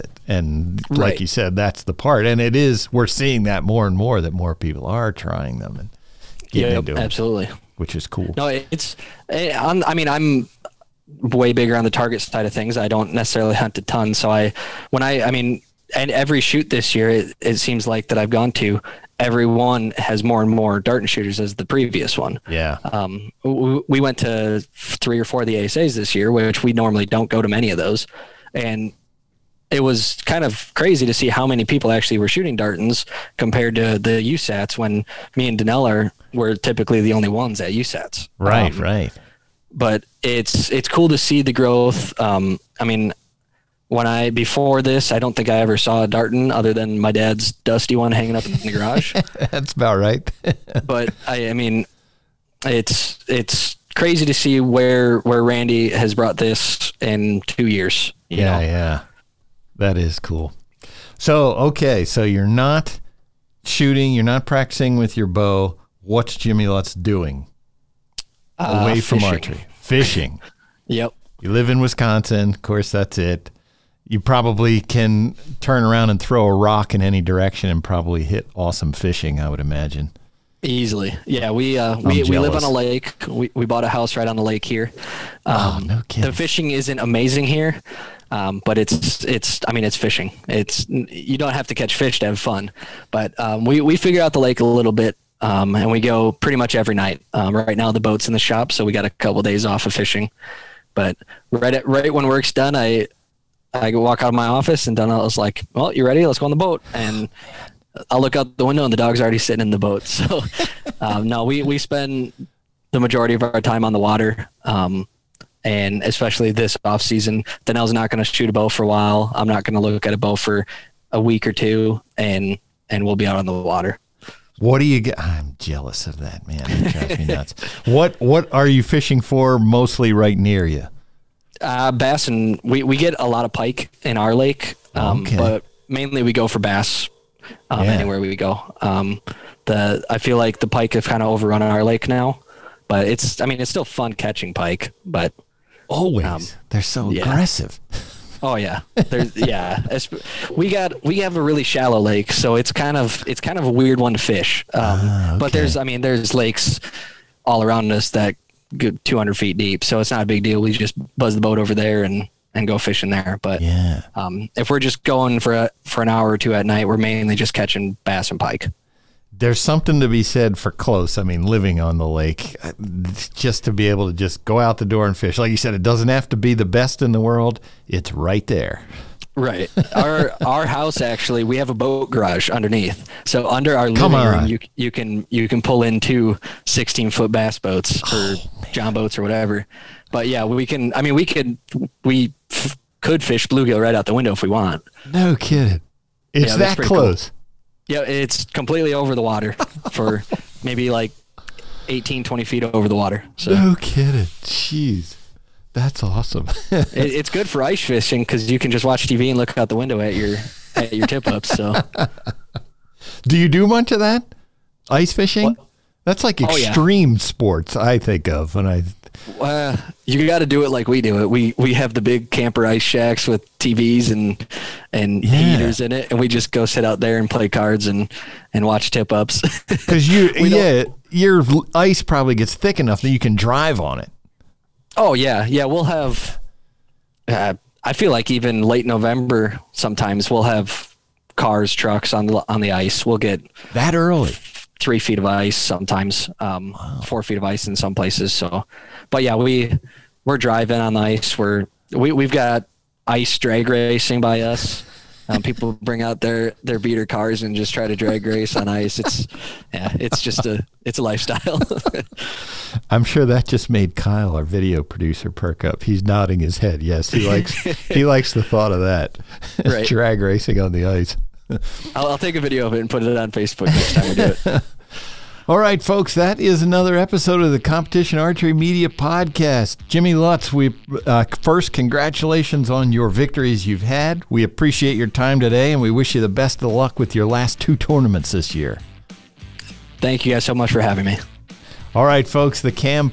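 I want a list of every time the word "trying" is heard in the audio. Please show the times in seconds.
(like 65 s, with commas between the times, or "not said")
5 s.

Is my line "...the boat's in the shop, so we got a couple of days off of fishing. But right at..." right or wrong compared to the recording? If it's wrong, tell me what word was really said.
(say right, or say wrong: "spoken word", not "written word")
right.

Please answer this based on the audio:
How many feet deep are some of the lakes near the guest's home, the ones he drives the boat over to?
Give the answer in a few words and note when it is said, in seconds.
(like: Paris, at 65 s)
200 feet, at 159 s.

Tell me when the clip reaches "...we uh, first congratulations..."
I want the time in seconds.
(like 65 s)
280 s.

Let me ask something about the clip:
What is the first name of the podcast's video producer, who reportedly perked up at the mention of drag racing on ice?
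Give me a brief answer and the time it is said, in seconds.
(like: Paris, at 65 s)
Kyle, at 263 s.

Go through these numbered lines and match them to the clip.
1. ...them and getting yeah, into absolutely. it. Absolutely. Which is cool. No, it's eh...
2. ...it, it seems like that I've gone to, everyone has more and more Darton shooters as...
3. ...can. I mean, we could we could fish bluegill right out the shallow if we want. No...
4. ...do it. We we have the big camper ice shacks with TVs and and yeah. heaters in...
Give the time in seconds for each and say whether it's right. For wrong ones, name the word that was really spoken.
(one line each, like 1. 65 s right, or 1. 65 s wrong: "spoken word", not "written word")
1. 5 s right
2. 17 s right
3. 190 s wrong: "window", not "shallow"
4. 221 s right.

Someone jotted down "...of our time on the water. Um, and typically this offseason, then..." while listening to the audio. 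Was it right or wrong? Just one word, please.
wrong.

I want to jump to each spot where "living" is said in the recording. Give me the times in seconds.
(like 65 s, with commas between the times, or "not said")
171 s, 184 s.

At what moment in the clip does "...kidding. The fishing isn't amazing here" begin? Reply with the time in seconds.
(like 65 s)
86 s.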